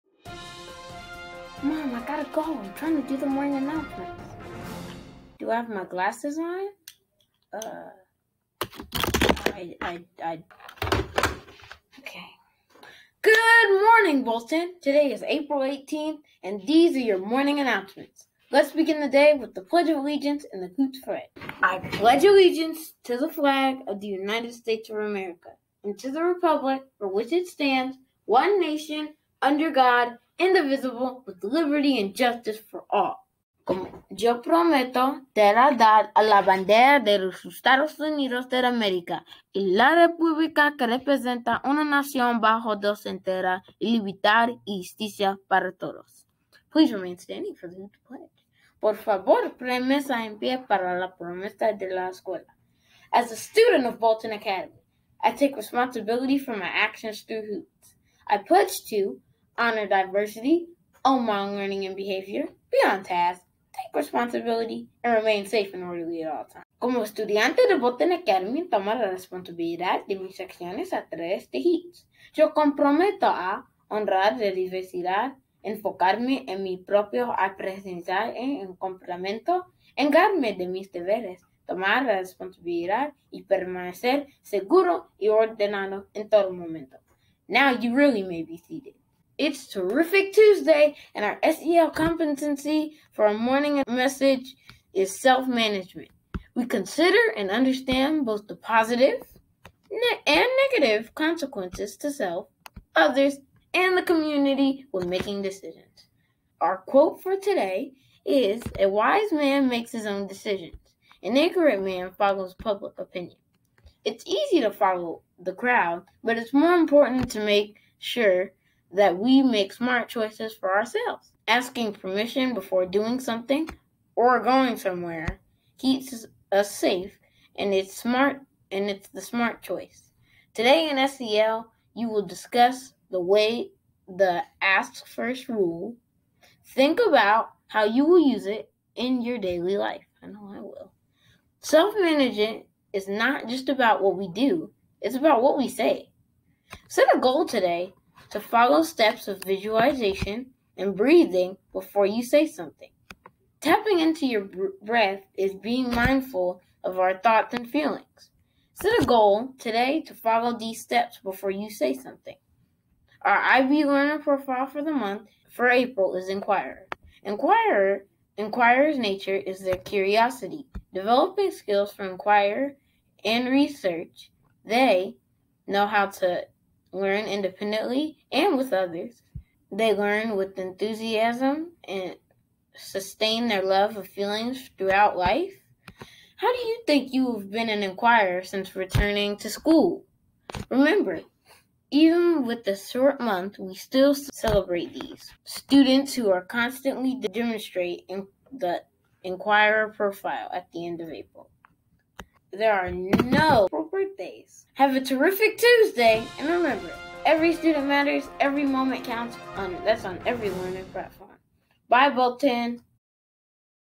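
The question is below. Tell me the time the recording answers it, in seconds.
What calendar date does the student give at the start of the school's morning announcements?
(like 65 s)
15 s.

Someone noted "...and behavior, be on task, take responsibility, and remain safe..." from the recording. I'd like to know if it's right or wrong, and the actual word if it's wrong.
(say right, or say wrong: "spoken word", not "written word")
right.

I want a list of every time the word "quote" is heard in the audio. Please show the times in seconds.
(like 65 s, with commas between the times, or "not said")
106 s.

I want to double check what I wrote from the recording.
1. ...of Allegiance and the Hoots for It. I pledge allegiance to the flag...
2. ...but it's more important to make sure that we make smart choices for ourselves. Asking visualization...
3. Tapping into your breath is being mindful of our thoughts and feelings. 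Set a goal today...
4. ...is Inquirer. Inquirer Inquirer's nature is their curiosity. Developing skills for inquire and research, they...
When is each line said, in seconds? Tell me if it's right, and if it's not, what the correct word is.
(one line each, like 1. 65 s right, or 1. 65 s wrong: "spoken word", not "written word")
1. 19 s right
2. 116 s wrong: "permission", not "visualization"
3. 153 s right
4. 166 s right.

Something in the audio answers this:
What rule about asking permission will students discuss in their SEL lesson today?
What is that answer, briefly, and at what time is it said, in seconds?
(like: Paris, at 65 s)
Ask first rule, at 134 s.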